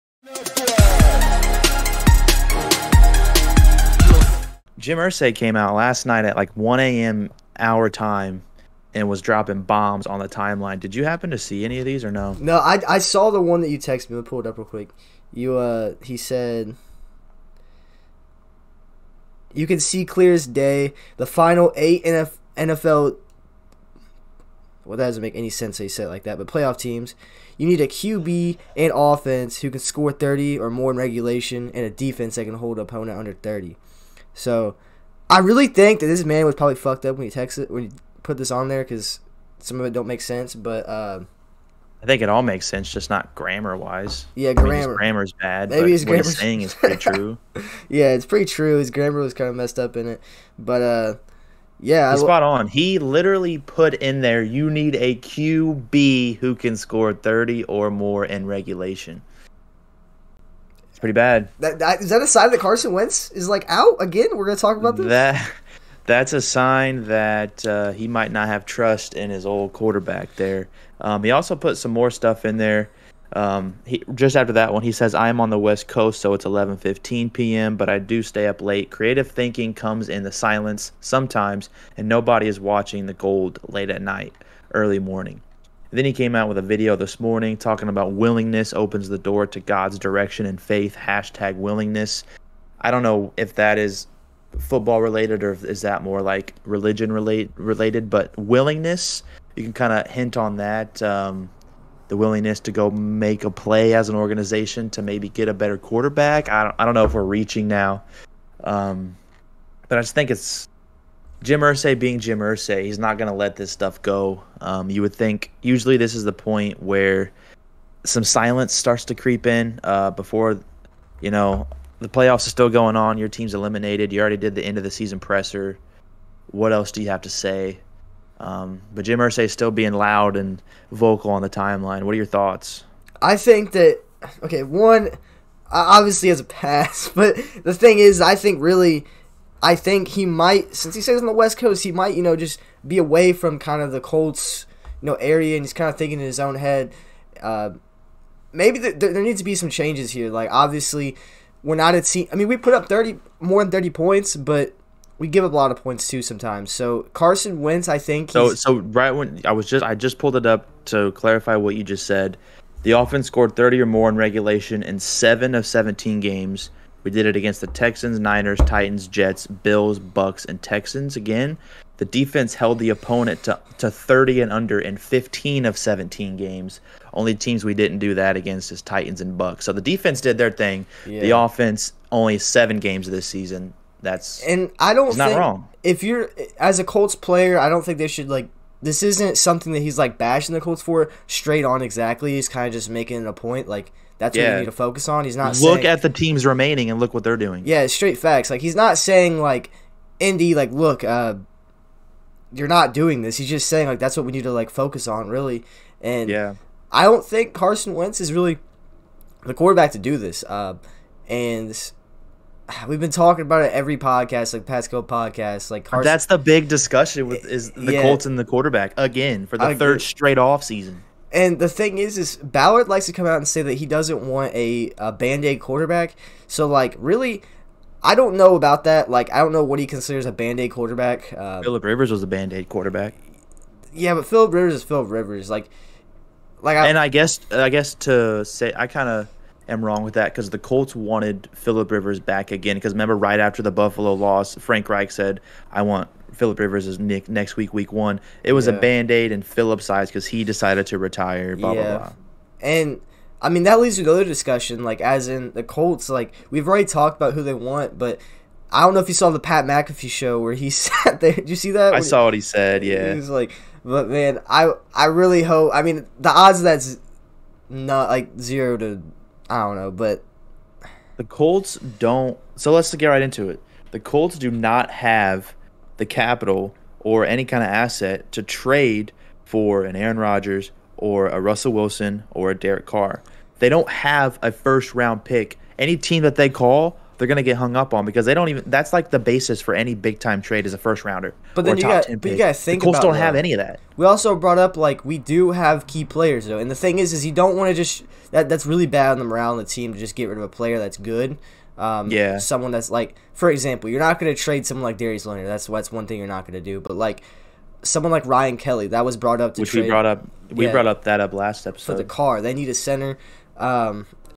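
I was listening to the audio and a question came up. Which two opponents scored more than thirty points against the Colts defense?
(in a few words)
Titans and Bucs.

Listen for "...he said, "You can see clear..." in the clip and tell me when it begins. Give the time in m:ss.
0:16.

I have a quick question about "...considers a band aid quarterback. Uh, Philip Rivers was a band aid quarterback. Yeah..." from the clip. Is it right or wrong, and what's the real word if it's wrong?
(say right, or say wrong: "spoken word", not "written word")
right.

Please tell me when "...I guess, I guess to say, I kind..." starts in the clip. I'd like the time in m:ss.
3:56.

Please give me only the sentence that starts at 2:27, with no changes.
Uh, maybe there needs to be some changes here.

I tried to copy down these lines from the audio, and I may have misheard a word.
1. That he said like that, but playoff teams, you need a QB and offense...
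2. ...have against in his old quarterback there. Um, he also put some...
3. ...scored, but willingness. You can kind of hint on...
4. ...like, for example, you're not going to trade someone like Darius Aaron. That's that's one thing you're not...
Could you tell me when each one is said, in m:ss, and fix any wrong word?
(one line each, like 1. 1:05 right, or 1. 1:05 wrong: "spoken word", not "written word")
1. 0:25 right
2. 1:08 wrong: "trust", not "against"
3. 1:37 wrong: "related", not "scored"
4. 5:02 wrong: "Leonard", not "Aaron".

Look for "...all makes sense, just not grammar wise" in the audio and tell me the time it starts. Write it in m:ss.
0:42.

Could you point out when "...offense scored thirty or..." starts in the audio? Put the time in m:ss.
2:42.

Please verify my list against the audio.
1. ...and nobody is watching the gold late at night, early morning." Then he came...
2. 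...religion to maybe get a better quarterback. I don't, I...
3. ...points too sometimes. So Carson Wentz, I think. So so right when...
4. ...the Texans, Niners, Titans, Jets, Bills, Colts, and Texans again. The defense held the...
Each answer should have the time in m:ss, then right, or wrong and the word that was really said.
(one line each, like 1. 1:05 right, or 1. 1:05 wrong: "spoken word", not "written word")
1. 1:21 right
2. 1:44 wrong: "organization", not "religion"
3. 2:35 right
4. 2:47 wrong: "Bucs", not "Colts".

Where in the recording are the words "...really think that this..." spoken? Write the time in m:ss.
0:35.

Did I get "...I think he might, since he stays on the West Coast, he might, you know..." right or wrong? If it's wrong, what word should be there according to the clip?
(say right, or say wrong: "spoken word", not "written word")
right.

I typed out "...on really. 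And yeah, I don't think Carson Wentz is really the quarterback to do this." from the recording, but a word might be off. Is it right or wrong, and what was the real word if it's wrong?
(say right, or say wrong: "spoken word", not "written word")
right.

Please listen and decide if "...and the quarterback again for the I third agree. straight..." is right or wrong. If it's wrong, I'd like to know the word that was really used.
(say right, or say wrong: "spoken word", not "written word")
right.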